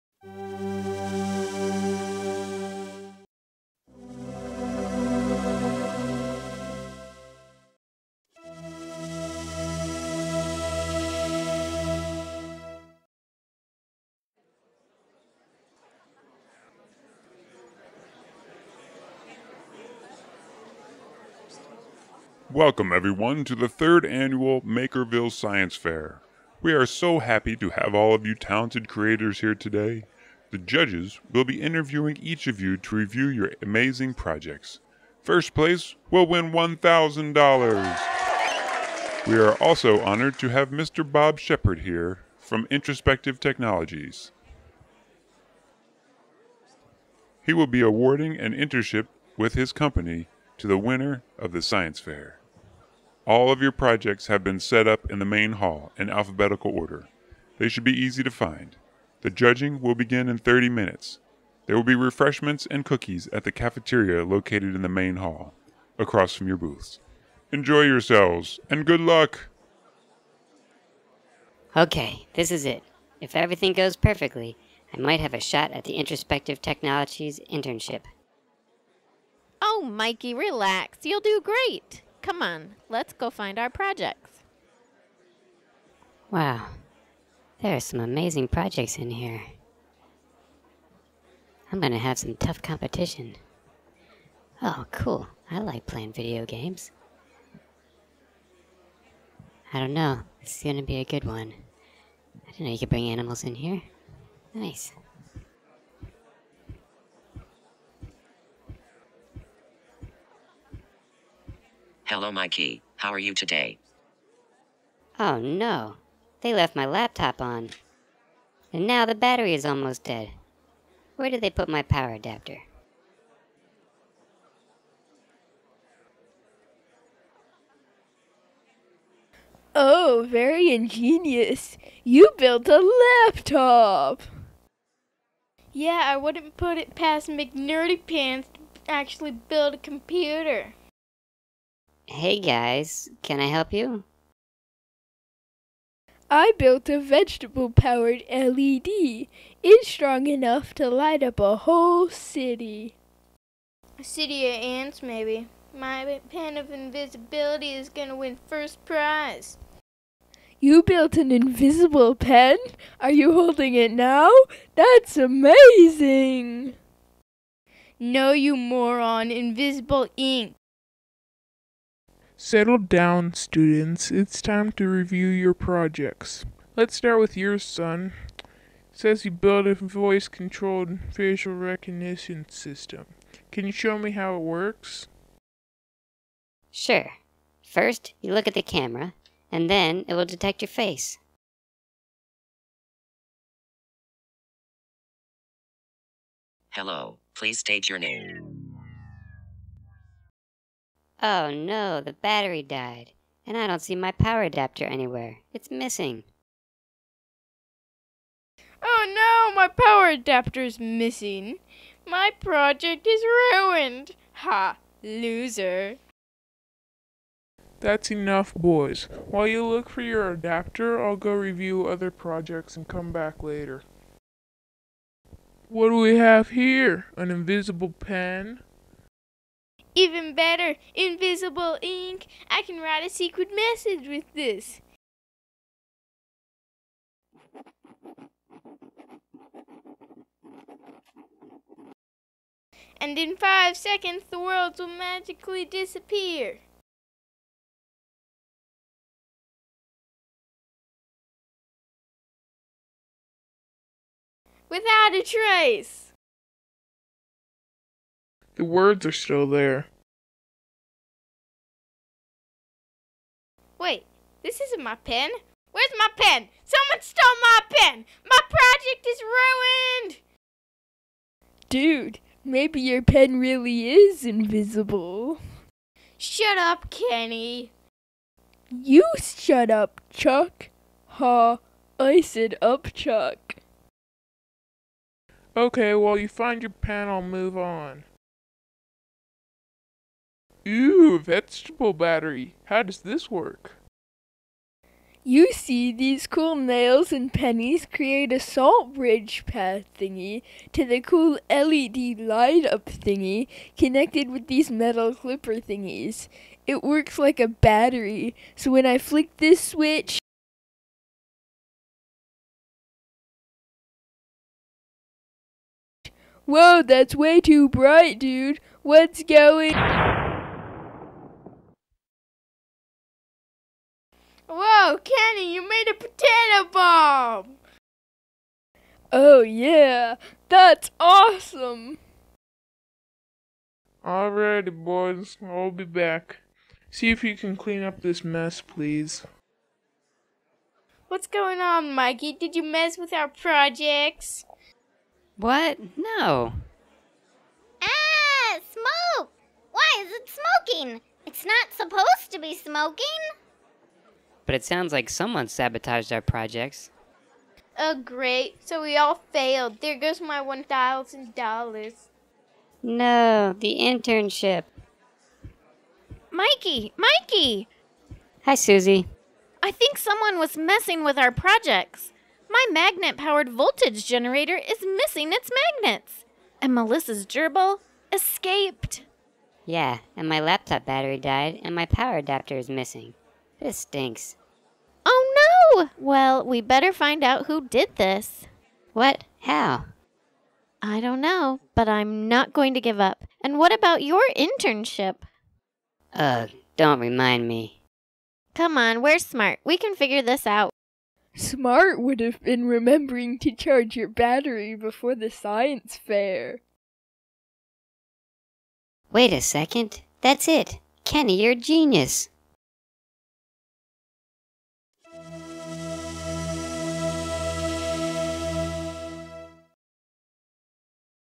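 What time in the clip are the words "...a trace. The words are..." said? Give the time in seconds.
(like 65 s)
255 s.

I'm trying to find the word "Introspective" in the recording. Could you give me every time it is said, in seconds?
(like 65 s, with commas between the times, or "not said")
42 s, 75 s.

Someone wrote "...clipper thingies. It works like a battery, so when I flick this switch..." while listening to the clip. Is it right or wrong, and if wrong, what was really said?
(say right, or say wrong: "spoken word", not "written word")
right.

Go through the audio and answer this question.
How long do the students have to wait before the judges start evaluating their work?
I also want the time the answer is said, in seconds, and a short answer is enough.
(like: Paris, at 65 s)
30 minutes, at 60 s.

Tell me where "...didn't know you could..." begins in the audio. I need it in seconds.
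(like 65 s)
102 s.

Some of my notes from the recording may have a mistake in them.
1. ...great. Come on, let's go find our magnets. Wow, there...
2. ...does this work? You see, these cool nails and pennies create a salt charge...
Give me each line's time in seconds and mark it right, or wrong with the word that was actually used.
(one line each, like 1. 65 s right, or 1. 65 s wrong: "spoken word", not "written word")
1. 81 s wrong: "projects", not "magnets"
2. 292 s wrong: "bridge", not "charge".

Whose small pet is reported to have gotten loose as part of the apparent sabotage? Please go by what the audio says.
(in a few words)
Melissa's.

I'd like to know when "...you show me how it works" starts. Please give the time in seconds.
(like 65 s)
183 s.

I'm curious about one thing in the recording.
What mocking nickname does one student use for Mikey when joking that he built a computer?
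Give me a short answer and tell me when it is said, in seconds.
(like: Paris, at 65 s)
McNerdy Pants, at 137 s.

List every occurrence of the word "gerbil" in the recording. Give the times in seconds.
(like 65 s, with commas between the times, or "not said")
377 s.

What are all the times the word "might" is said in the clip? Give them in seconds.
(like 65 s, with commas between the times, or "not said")
74 s.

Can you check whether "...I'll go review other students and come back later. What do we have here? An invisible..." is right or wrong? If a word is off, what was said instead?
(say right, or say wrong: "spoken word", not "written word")
wrong: "projects", not "students".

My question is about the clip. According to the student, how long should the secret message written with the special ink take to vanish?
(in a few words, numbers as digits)
5 seconds.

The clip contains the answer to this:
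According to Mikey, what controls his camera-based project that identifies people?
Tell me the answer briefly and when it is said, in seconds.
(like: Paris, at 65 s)
Voice, at 179 s.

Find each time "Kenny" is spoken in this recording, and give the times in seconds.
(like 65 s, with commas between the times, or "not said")
276 s, 325 s, 411 s.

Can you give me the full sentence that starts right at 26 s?
We are so happy to have all of you talented creators here today.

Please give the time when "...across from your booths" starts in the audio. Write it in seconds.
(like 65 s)
65 s.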